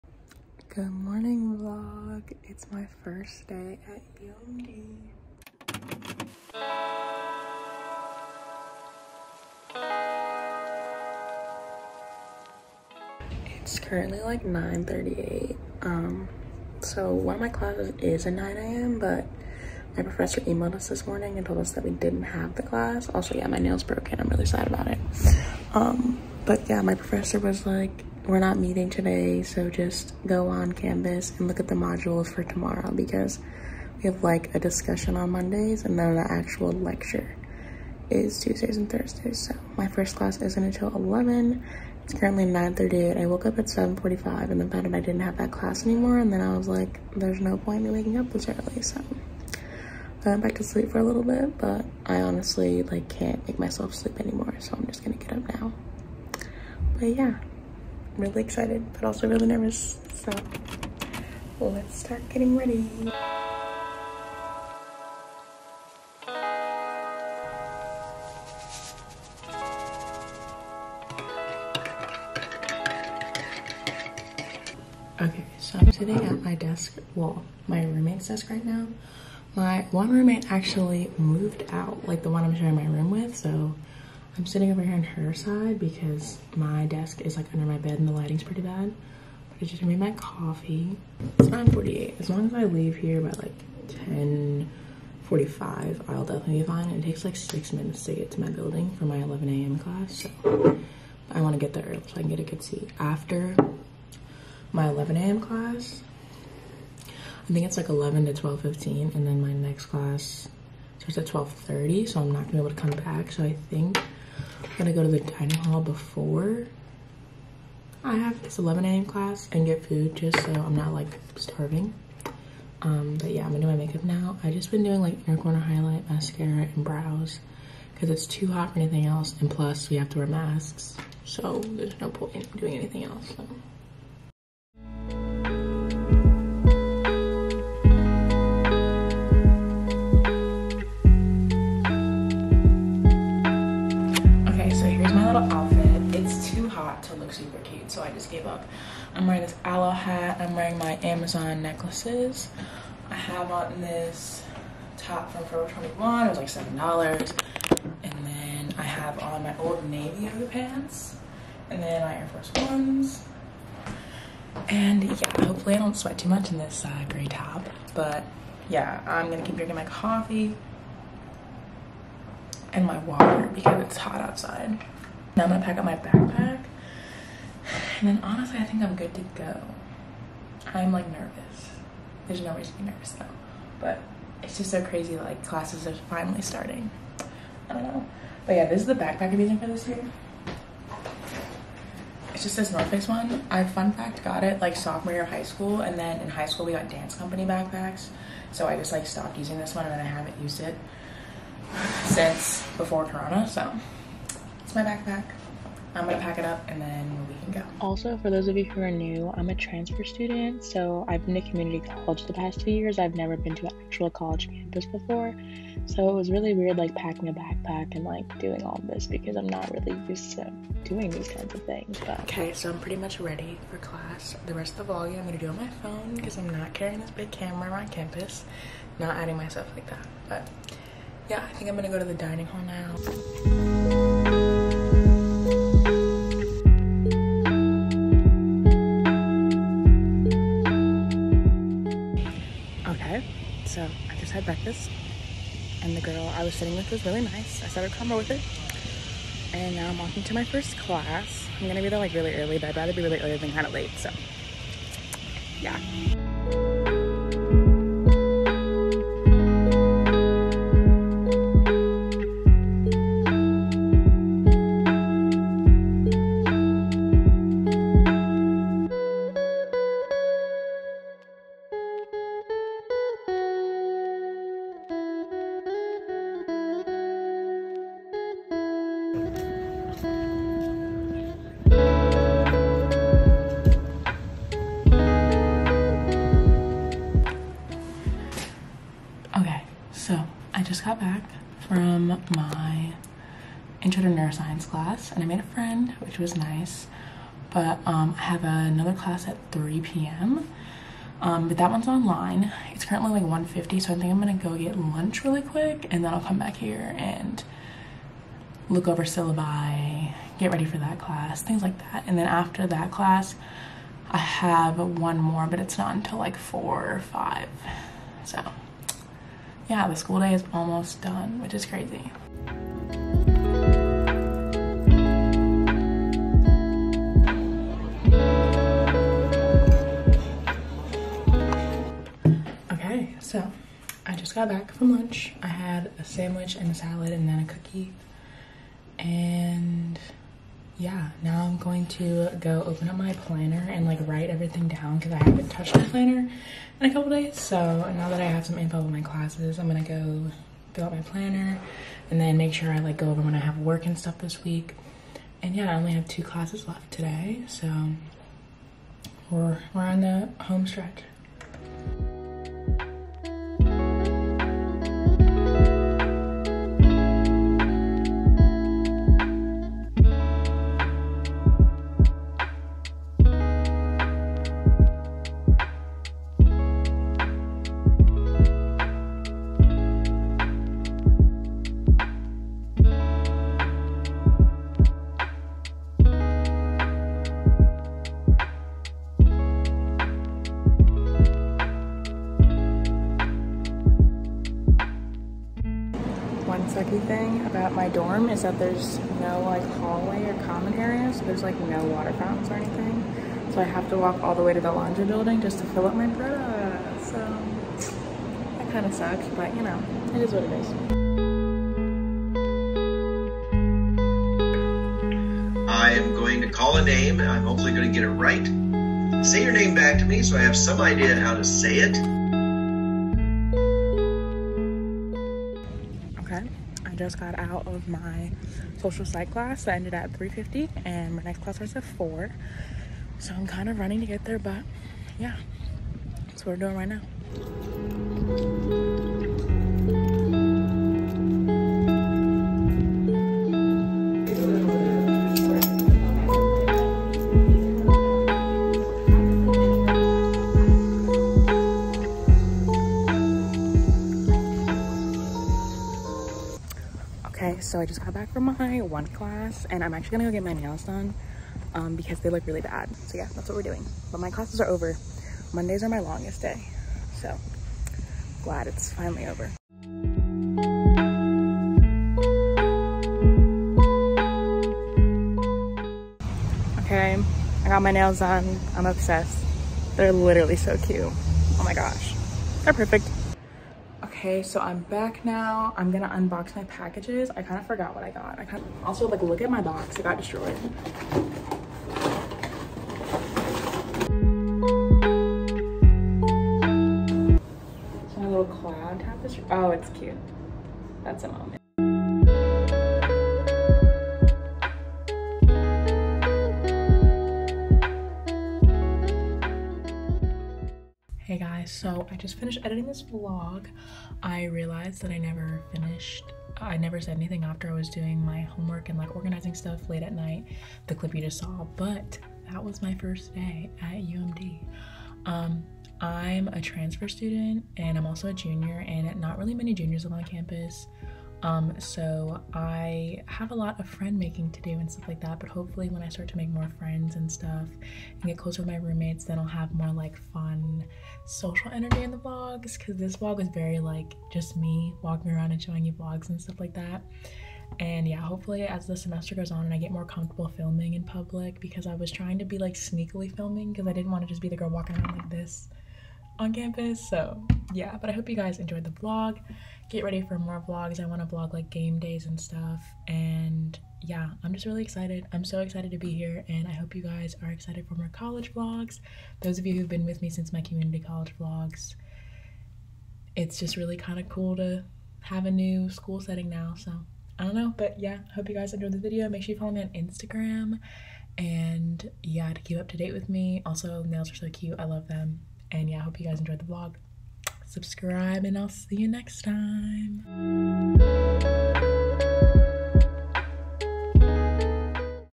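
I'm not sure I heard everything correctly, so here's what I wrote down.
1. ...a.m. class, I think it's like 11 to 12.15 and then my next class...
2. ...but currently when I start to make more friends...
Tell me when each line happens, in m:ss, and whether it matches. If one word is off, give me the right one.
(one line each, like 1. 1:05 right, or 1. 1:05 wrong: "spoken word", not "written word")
1. 1:45 right
2. 8:55 wrong: "hopefully", not "currently".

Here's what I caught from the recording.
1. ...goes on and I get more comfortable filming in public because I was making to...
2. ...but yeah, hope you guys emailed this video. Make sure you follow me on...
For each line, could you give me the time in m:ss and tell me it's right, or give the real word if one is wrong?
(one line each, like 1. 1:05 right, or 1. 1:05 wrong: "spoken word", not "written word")
1. 9:09 wrong: "trying", not "making"
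2. 9:37 wrong: "enjoyed", not "emailed".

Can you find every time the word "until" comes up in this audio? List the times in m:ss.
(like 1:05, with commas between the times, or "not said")
0:40, 5:15.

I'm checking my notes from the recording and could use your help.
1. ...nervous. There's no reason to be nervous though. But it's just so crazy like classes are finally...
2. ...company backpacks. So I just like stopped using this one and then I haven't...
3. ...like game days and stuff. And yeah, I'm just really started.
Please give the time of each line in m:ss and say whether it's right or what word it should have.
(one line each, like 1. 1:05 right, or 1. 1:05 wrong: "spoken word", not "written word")
1. 3:01 right
2. 3:17 right
3. 9:21 wrong: "excited", not "started".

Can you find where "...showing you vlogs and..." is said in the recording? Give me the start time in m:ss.
9:05.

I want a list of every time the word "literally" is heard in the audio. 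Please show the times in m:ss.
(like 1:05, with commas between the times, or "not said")
8:00.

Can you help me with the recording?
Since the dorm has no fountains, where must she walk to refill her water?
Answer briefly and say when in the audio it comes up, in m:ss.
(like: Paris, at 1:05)
The laundry building, at 6:44.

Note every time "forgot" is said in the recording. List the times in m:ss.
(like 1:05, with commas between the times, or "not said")
8:07.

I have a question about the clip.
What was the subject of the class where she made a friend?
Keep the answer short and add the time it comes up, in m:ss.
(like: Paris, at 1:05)
Intro to neuroscience, at 4:53.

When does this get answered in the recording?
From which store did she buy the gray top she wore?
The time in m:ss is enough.
2:35.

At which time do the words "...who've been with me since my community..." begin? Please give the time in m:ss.
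9:29.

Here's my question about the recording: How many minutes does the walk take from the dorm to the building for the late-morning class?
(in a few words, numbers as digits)
6.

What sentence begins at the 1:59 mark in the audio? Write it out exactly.
class and get food just so I'm not like starving.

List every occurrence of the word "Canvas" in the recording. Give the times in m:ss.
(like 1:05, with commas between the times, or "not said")
0:30.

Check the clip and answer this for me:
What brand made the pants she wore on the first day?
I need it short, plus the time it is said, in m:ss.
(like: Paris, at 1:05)
Old Navy, at 2:39.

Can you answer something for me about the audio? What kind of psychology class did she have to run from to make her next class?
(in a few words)
Social psych.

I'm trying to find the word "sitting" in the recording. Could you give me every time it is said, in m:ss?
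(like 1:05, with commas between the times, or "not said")
1:15, 1:24, 4:06.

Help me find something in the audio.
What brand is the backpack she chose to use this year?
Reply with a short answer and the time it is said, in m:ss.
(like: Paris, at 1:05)
North Face, at 3:12.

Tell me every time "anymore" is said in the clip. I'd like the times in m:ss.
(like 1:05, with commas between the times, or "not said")
0:45, 0:54.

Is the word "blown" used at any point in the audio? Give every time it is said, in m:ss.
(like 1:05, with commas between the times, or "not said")
not said.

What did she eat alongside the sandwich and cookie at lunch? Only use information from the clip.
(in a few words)
A salad.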